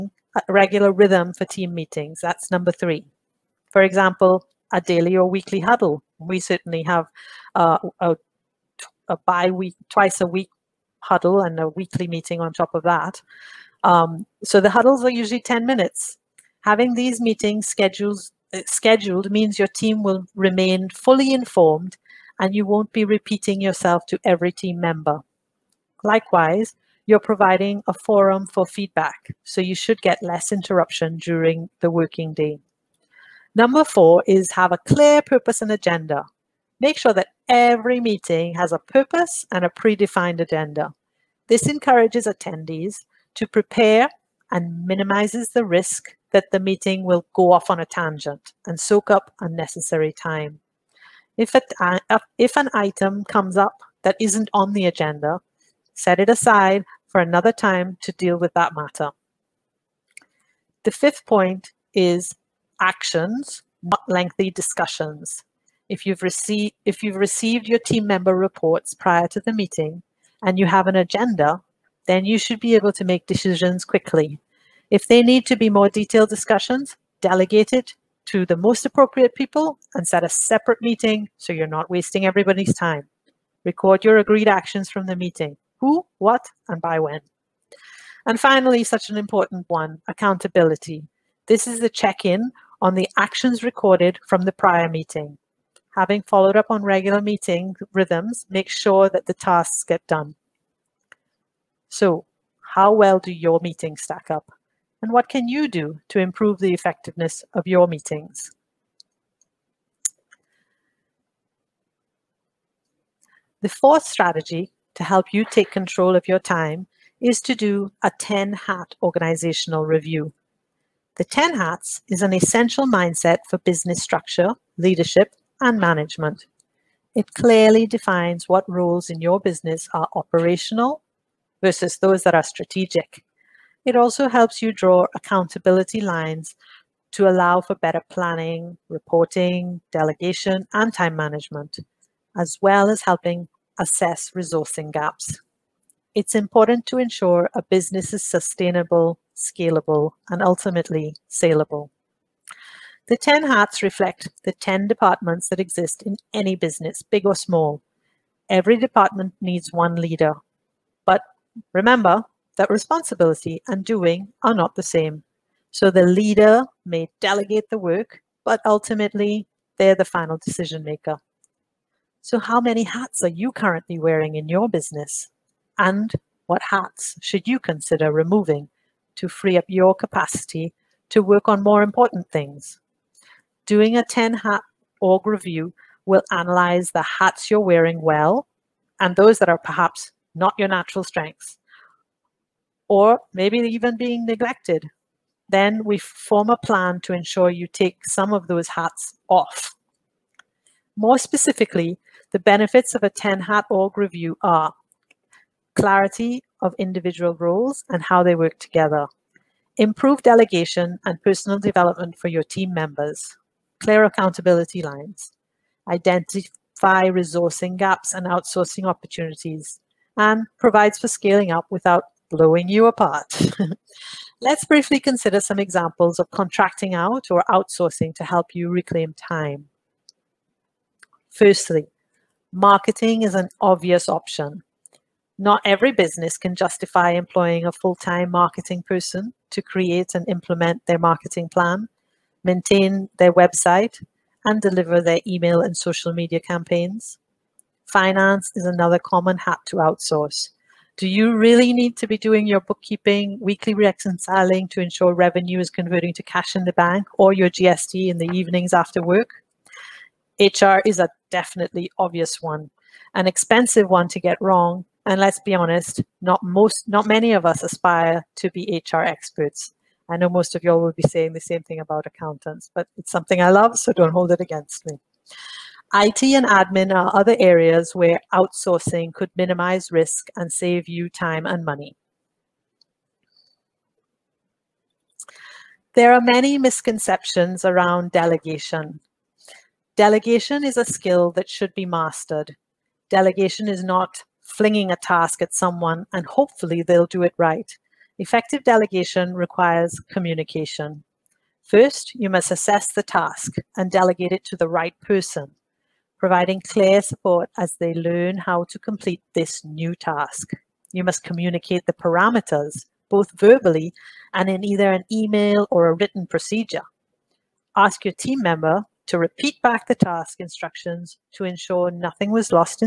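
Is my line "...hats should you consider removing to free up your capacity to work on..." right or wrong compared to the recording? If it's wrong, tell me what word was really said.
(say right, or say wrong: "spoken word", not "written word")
right.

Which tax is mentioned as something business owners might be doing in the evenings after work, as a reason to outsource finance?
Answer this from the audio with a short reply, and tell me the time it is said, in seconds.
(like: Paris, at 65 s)
GST, at 257 s.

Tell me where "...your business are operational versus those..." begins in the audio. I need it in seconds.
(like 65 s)
129 s.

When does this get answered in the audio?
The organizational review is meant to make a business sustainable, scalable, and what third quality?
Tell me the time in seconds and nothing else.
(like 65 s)
151 s.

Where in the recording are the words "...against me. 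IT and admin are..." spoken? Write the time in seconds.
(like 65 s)
274 s.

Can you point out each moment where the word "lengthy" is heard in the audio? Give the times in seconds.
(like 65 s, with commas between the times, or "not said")
64 s.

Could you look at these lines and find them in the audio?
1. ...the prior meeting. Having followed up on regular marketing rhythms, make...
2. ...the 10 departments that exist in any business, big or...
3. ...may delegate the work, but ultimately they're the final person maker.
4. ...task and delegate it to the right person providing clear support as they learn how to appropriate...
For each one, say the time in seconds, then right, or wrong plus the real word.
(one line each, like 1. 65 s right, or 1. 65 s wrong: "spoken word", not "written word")
1. 94 s wrong: "meeting", not "marketing"
2. 154 s right
3. 166 s wrong: "decision", not "person"
4. 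303 s wrong: "complete", not "appropriate".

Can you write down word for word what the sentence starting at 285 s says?
There are many misconceptions around delegation.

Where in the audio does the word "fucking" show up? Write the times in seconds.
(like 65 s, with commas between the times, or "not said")
not said.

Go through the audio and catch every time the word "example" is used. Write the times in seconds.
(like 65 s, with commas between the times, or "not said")
3 s, 225 s.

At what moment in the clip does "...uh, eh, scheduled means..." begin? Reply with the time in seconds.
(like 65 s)
18 s.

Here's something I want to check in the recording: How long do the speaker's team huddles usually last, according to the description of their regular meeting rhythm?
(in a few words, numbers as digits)
10 minutes.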